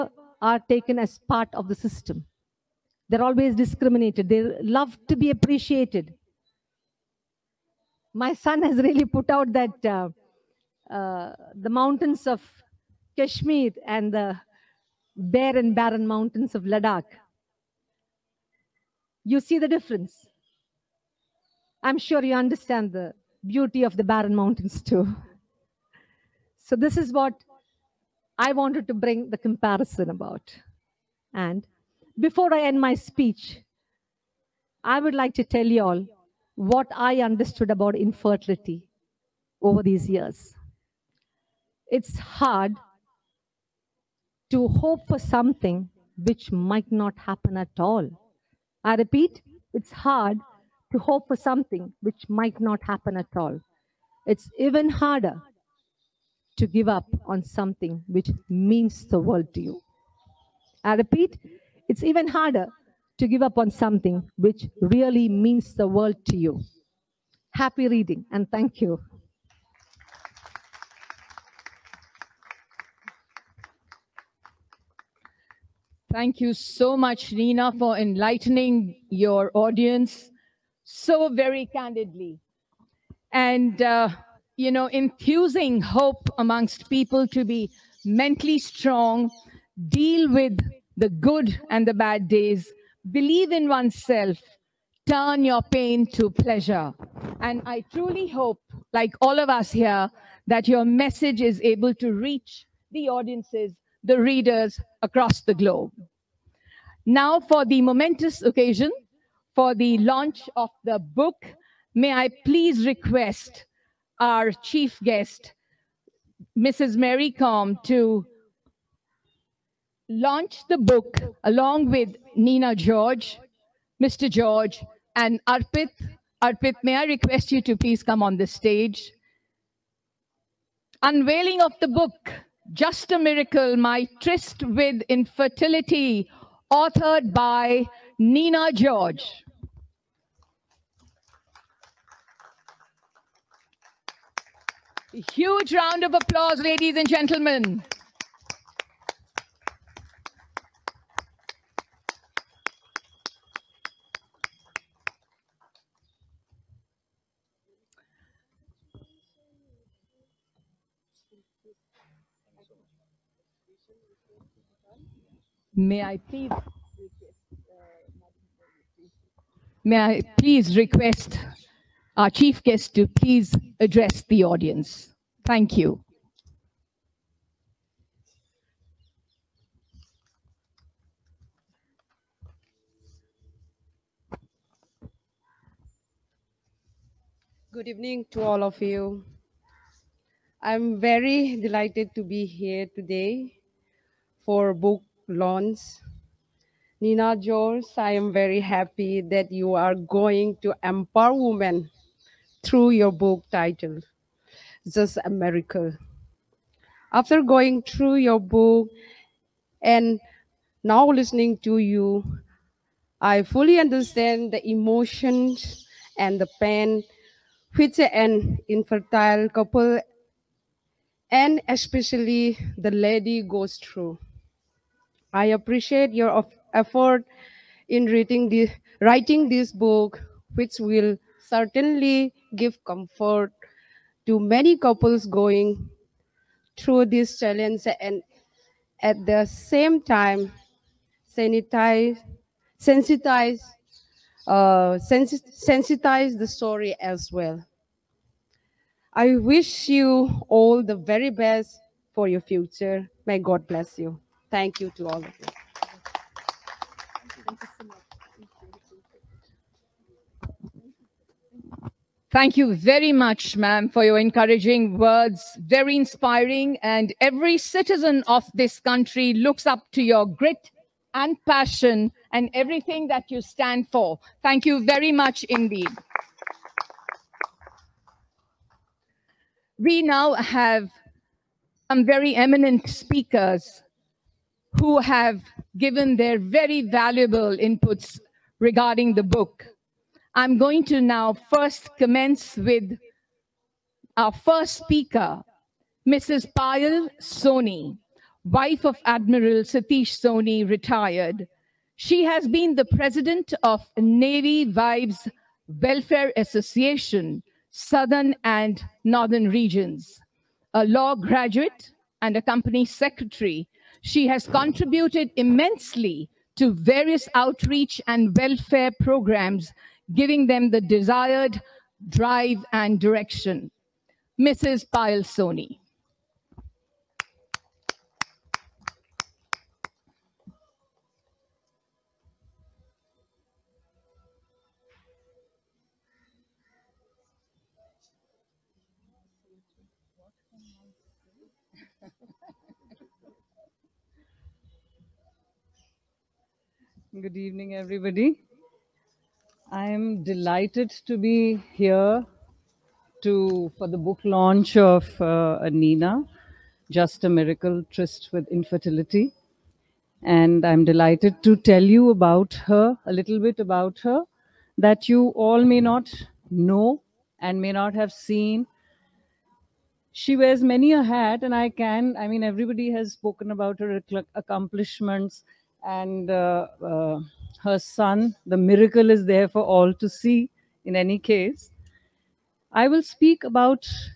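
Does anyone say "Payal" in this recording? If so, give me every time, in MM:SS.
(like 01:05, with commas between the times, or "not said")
04:56, 05:24.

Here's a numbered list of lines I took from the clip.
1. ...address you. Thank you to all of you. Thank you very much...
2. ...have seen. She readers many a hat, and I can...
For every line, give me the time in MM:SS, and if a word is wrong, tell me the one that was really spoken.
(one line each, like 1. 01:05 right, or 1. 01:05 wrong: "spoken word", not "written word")
1. 04:13 wrong: "bless", not "address"
2. 06:07 wrong: "wears", not "readers".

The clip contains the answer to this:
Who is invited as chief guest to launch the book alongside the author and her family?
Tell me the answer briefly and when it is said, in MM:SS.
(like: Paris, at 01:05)
Mary Kom, at 01:56.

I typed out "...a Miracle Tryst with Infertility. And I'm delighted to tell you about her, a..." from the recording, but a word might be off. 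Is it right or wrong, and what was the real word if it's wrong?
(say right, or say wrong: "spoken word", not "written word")
right.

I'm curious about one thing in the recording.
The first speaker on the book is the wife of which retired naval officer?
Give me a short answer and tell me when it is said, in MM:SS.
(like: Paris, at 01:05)
Admiral Satish Soni, at 04:59.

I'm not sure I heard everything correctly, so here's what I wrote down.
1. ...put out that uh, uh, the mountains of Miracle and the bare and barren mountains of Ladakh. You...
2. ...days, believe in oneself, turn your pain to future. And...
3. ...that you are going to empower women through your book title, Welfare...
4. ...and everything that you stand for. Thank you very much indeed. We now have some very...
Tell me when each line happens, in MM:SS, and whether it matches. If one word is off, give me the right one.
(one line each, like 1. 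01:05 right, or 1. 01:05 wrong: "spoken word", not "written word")
1. 00:09 wrong: "Kashmir", not "Miracle"
2. 01:32 wrong: "pleasure", not "future"
3. 03:19 wrong: "Just", not "Welfare"
4. 04:32 right.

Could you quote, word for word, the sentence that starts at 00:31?
And before I end my speech, I would like to tell you all what I understood about infertility over these years.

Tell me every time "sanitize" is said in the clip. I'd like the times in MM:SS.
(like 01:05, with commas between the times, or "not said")
04:01.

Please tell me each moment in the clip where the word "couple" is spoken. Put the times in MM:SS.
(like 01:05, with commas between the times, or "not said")
03:39, 03:54.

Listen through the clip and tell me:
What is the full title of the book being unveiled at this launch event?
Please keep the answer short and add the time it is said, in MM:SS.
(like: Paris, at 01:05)
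Just a Miracle My Tryst with Infertility, at 02:12.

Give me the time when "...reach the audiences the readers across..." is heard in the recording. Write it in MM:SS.
01:42.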